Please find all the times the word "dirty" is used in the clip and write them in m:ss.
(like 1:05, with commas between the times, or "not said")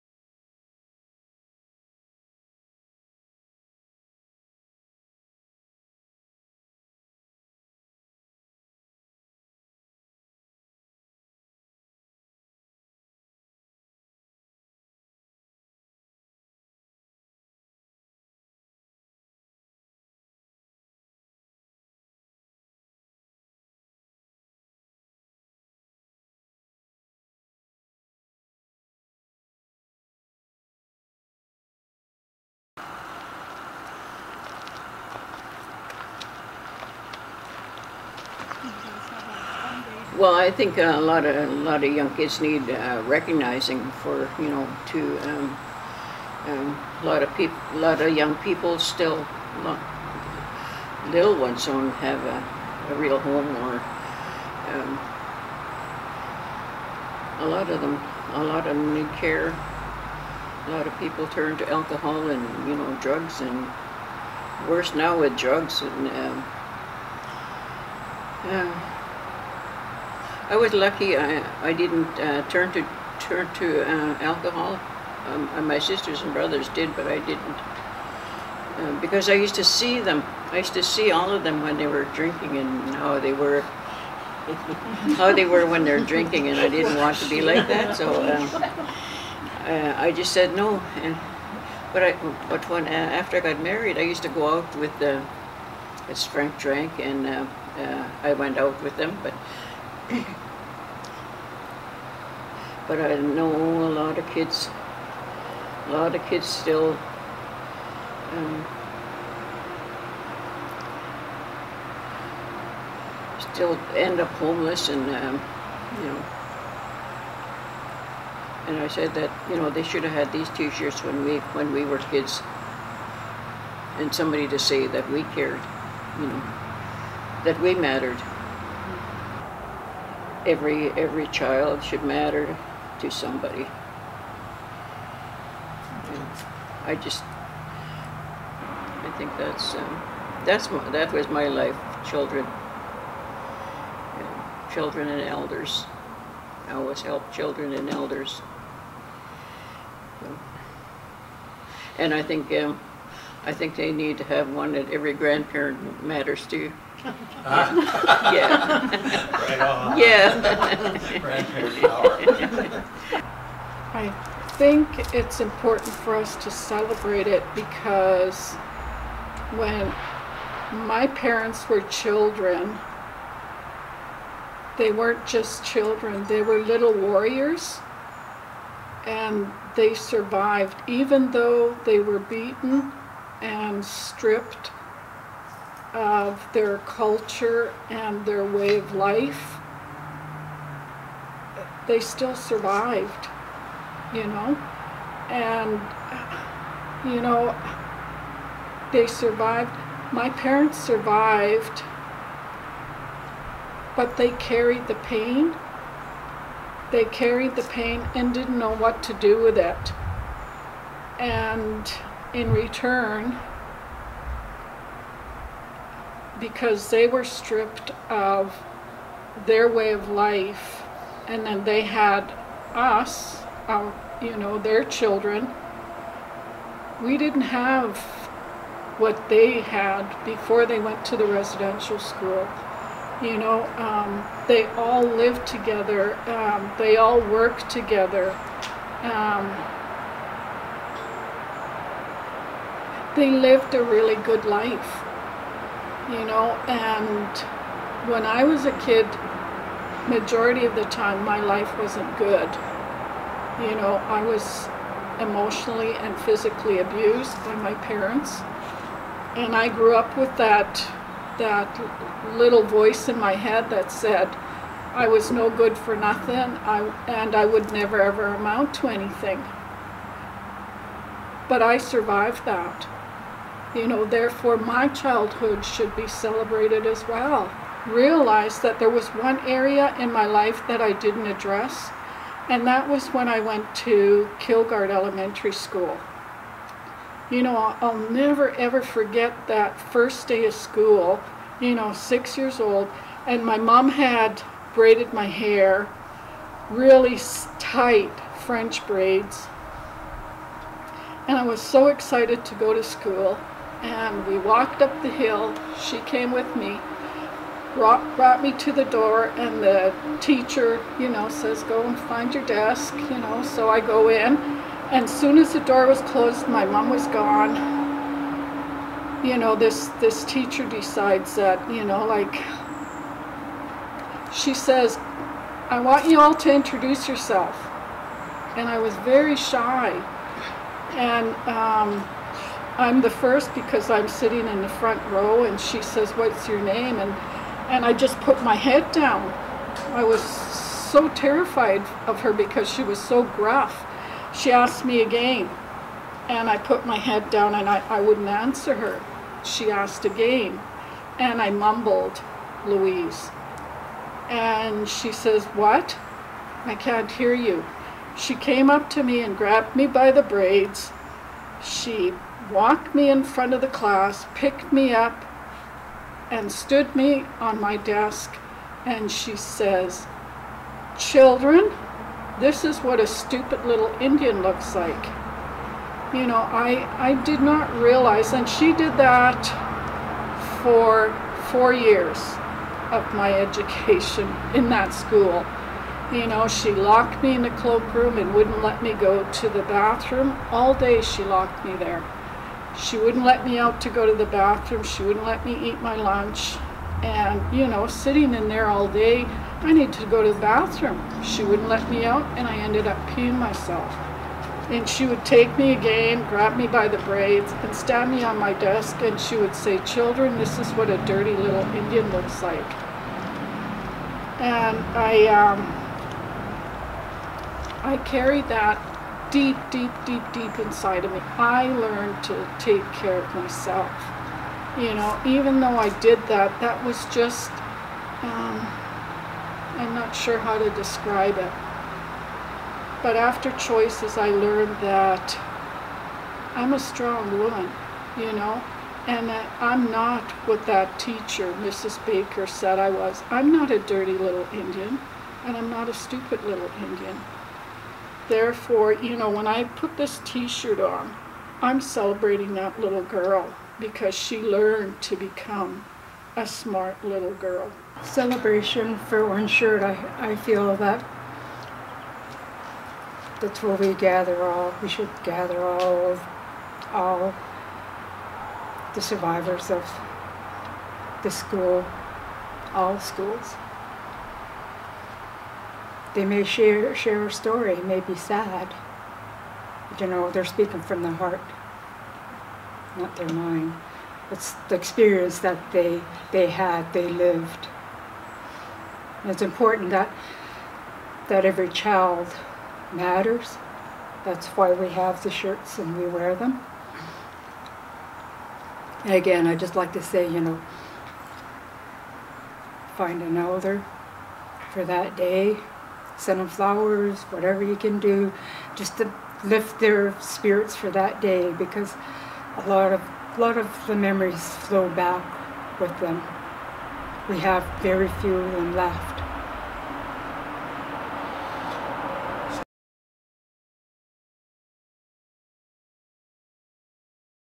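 6:51, 7:23.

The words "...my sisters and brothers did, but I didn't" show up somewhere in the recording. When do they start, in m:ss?
1:15.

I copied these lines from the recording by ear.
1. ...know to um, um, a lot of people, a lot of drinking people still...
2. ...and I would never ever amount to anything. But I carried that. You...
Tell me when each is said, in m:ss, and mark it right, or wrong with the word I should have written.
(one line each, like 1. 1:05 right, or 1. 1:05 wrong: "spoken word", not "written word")
1. 0:44 wrong: "young", not "drinking"
2. 4:27 wrong: "survived", not "carried".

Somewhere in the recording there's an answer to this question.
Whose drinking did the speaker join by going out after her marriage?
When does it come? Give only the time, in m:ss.
1:36.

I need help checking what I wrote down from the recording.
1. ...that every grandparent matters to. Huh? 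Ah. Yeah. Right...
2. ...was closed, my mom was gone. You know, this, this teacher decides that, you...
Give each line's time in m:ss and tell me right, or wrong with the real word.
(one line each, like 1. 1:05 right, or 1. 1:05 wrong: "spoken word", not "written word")
1. 2:34 right
2. 5:15 right.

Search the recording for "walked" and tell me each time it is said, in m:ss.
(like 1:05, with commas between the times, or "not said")
5:04, 6:02.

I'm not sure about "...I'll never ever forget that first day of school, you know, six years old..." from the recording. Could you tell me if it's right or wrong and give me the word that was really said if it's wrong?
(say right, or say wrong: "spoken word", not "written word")
right.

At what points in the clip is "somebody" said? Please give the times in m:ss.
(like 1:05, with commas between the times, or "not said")
2:04, 2:13.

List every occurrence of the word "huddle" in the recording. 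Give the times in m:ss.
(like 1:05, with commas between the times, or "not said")
not said.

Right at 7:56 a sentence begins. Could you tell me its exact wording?
They may share, share a story, may be sad.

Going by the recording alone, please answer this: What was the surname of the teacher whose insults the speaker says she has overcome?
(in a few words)
Baker.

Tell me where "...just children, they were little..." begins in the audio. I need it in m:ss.
2:55.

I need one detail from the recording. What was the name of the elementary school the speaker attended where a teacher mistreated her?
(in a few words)
Kilgard Elementary School.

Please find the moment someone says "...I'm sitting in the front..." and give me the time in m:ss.
5:33.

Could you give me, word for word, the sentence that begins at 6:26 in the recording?
You know, she locked me in the cloakroom and wouldn't let me go to the bathroom.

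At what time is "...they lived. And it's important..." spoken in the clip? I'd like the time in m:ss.
8:06.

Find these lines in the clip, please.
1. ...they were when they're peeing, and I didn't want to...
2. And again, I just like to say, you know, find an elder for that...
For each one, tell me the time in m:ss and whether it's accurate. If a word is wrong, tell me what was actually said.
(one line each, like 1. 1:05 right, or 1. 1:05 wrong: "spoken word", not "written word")
1. 1:25 wrong: "drinking", not "peeing"
2. 8:19 right.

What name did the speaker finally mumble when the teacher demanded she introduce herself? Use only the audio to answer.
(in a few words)
Louise.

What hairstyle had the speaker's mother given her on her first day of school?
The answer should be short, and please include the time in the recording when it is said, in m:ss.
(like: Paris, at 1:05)
French braids, at 4:58.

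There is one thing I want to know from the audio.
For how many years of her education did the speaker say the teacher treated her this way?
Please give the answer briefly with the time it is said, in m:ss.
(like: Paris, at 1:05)
4, at 6:21.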